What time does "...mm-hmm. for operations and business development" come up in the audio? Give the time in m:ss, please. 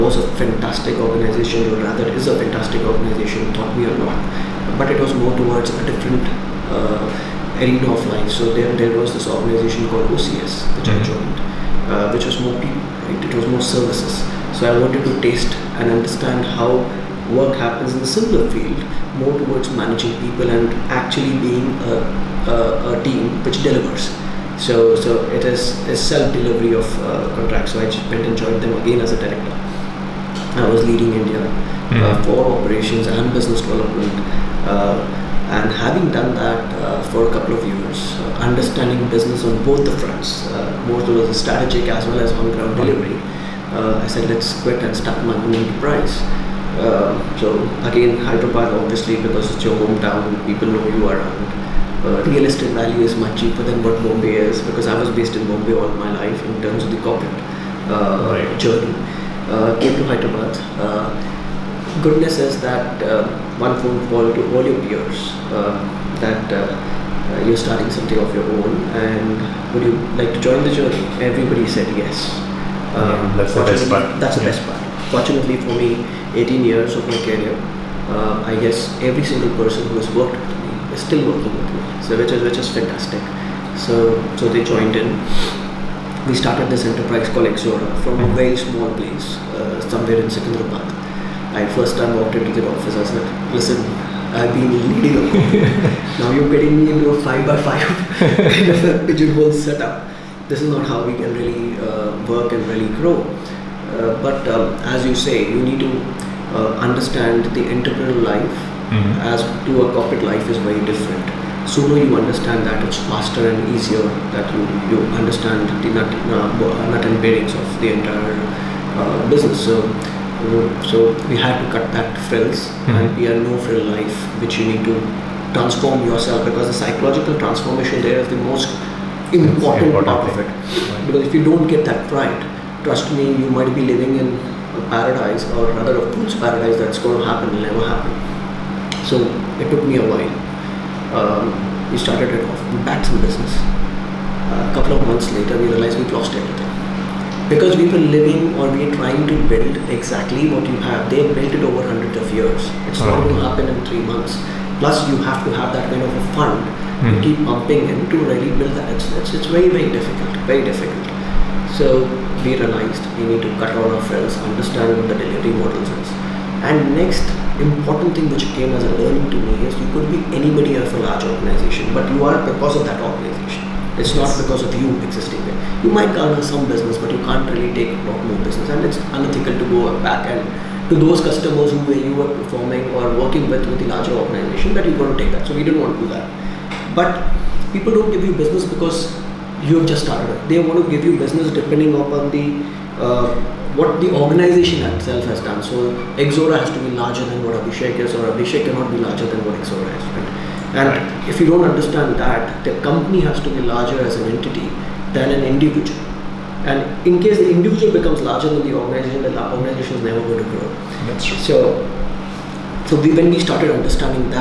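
0:31.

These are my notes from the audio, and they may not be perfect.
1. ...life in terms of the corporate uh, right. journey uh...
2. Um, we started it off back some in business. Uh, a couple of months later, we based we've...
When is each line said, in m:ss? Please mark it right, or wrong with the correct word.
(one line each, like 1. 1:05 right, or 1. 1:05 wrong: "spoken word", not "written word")
1. 0:56 right
2. 2:21 wrong: "realized", not "based".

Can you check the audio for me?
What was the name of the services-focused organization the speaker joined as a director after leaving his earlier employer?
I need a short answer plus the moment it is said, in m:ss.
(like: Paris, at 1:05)
OCS, at 0:10.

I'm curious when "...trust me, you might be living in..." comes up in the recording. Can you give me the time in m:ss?
2:12.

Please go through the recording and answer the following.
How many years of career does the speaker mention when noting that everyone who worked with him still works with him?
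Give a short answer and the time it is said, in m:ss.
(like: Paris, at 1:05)
18, at 1:16.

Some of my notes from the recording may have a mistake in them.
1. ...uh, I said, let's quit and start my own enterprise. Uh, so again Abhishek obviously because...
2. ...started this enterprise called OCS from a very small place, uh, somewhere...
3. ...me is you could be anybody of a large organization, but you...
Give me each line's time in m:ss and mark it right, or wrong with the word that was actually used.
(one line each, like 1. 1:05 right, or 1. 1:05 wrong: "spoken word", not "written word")
1. 0:43 wrong: "Hyderabad", not "Abhishek"
2. 1:26 wrong: "Ixora", not "OCS"
3. 2:49 right.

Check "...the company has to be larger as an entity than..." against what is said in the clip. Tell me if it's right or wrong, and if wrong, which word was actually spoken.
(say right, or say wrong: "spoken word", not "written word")
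right.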